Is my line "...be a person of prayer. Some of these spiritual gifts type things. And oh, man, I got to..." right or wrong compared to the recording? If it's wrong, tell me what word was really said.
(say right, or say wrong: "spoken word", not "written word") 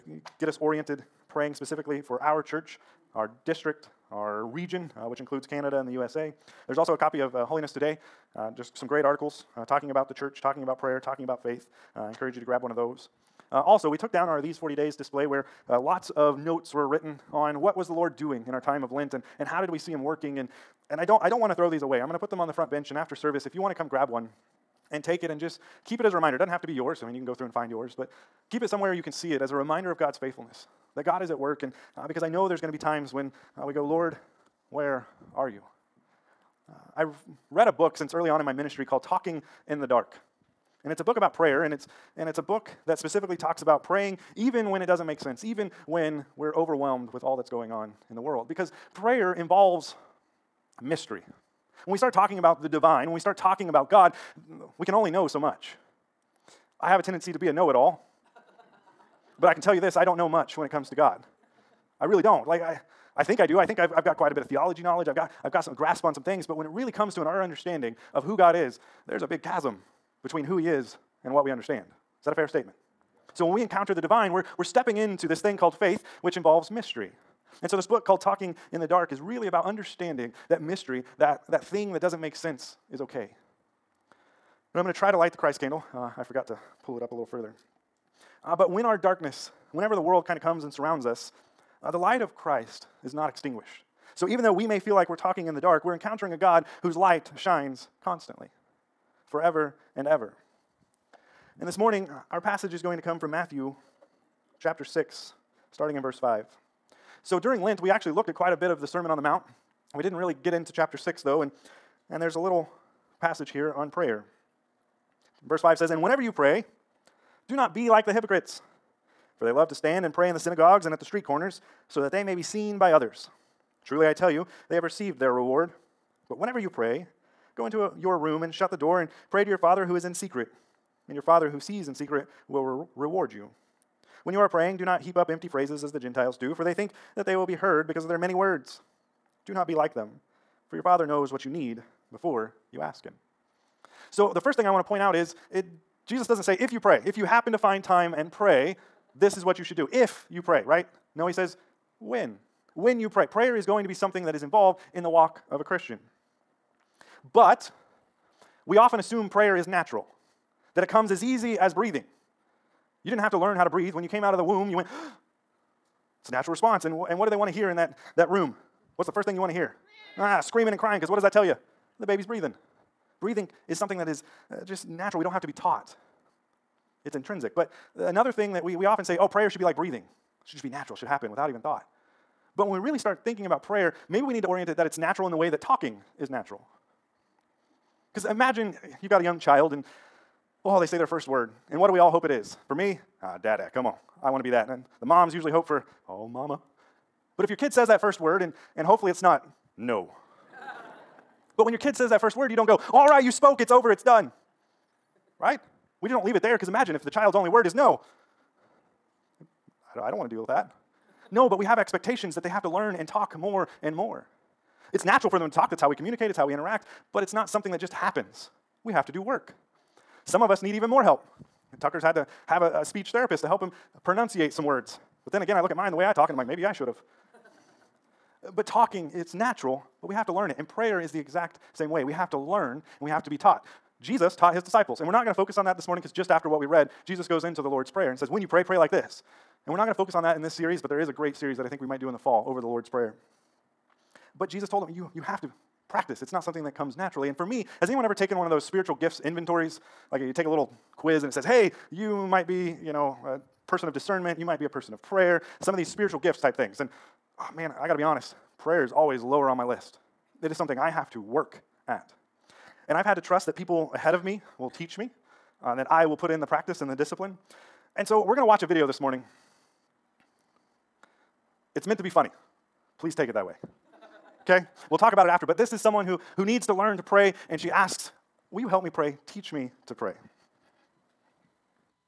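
right.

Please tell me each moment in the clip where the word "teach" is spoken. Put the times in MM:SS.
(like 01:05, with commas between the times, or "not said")
04:24, 04:39.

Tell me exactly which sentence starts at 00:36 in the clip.
Uh, I read a book since early on in my ministry called Talking in the Dark.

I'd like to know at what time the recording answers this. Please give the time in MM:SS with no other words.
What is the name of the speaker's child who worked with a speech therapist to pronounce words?
03:41.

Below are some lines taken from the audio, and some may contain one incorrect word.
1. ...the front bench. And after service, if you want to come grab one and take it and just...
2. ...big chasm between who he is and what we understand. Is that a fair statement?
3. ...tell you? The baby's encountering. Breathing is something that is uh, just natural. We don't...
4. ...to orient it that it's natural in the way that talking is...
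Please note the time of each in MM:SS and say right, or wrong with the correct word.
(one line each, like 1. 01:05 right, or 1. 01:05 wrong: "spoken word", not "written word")
1. 00:22 right
2. 01:09 right
3. 02:51 wrong: "breathing", not "encountering"
4. 03:04 right.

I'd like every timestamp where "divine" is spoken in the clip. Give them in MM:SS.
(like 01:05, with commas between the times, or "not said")
00:52, 01:14.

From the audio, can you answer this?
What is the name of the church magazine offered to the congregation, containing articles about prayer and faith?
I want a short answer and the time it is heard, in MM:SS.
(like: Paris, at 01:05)
Holiness Today, at 00:07.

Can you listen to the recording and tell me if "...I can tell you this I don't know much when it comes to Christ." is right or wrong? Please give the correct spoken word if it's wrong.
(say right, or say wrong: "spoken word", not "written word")
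wrong: "God", not "Christ".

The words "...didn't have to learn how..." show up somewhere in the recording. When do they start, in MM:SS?
02:43.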